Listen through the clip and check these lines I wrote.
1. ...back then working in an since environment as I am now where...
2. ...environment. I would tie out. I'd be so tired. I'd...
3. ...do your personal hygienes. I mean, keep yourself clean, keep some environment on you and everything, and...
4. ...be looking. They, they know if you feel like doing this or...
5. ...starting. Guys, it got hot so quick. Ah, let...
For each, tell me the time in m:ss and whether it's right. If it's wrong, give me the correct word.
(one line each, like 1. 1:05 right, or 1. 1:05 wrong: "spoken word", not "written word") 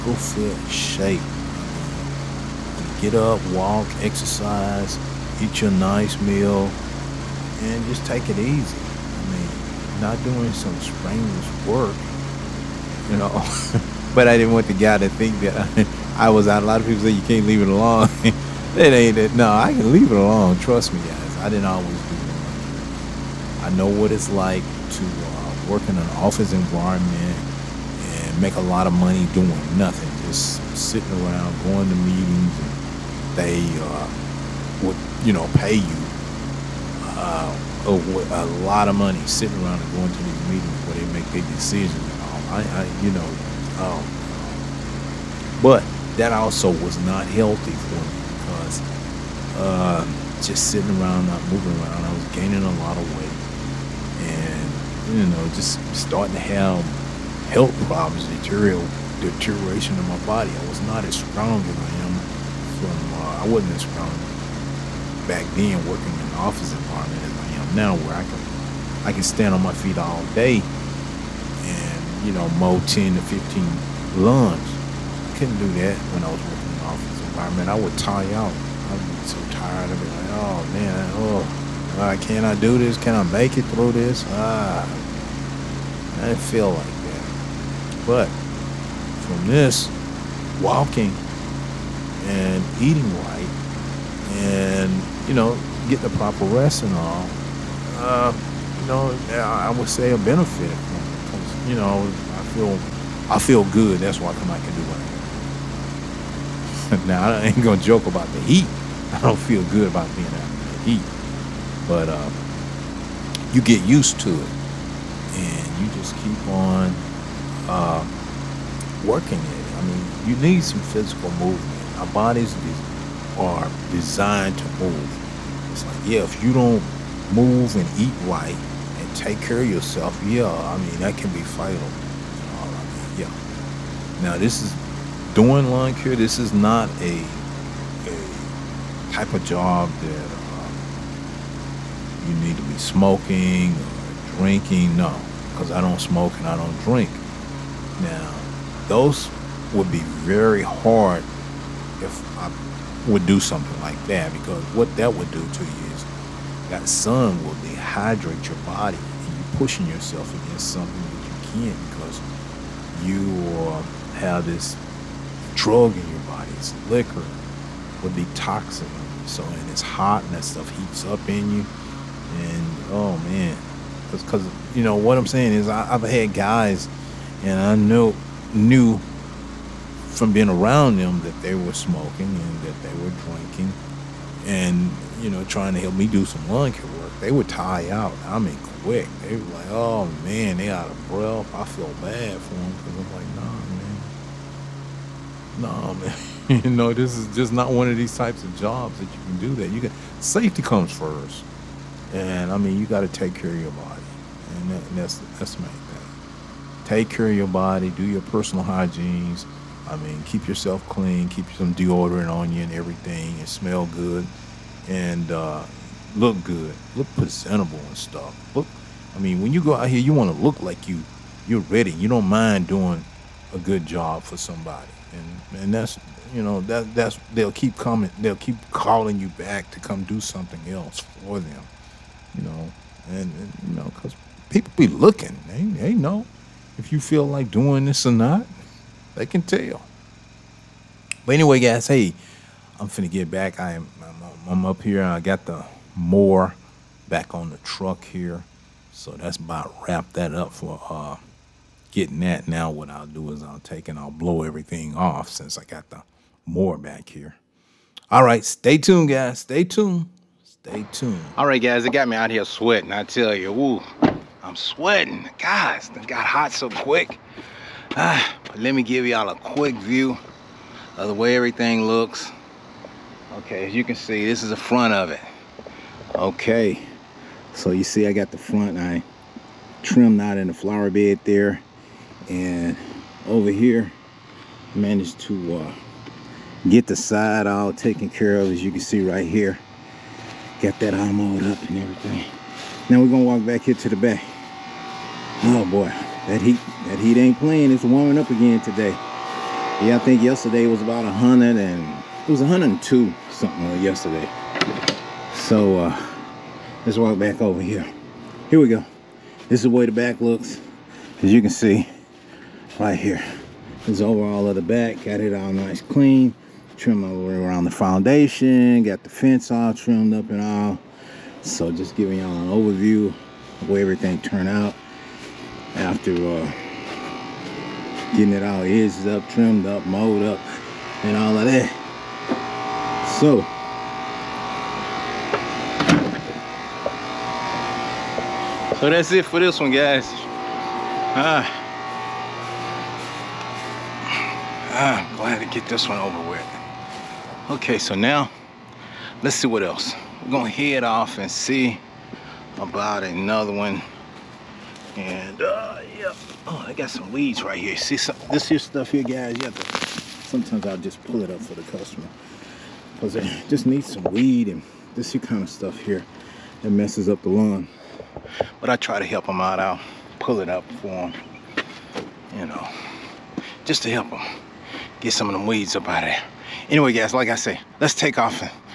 1. 1:05 wrong: "office", not "since"
2. 1:17 right
3. 3:27 wrong: "deodorant", not "environment"
4. 3:54 right
5. 4:24 wrong: "sweating", not "starting".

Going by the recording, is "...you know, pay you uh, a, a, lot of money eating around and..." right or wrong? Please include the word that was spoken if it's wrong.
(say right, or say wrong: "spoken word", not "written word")
wrong: "sitting", not "eating".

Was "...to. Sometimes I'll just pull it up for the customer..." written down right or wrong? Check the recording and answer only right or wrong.
right.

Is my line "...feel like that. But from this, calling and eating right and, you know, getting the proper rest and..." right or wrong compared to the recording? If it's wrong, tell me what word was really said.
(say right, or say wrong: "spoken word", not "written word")
wrong: "walking", not "calling".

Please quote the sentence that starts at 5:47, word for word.
Okay, so now let's see what else.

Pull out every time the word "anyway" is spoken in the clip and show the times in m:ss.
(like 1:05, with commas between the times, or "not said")
4:01, 6:16.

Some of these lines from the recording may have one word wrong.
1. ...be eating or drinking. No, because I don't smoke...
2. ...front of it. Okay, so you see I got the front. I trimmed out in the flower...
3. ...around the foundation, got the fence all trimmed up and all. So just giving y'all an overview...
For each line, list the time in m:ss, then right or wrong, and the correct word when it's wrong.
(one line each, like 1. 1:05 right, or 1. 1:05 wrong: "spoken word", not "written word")
1. 2:22 wrong: "smoking", not "eating"
2. 4:34 right
3. 5:17 right.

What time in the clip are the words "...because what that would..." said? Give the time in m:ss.
2:34.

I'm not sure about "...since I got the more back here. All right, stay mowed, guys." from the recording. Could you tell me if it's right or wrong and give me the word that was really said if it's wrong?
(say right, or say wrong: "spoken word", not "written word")
wrong: "tuned", not "mowed".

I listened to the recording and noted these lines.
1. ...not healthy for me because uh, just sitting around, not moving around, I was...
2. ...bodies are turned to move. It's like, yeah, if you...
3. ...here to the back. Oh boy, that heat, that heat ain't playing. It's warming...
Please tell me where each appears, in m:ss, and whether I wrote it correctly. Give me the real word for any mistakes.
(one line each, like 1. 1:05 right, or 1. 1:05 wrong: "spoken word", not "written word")
1. 0:47 right
2. 2:02 wrong: "designed", not "turned"
3. 4:53 right.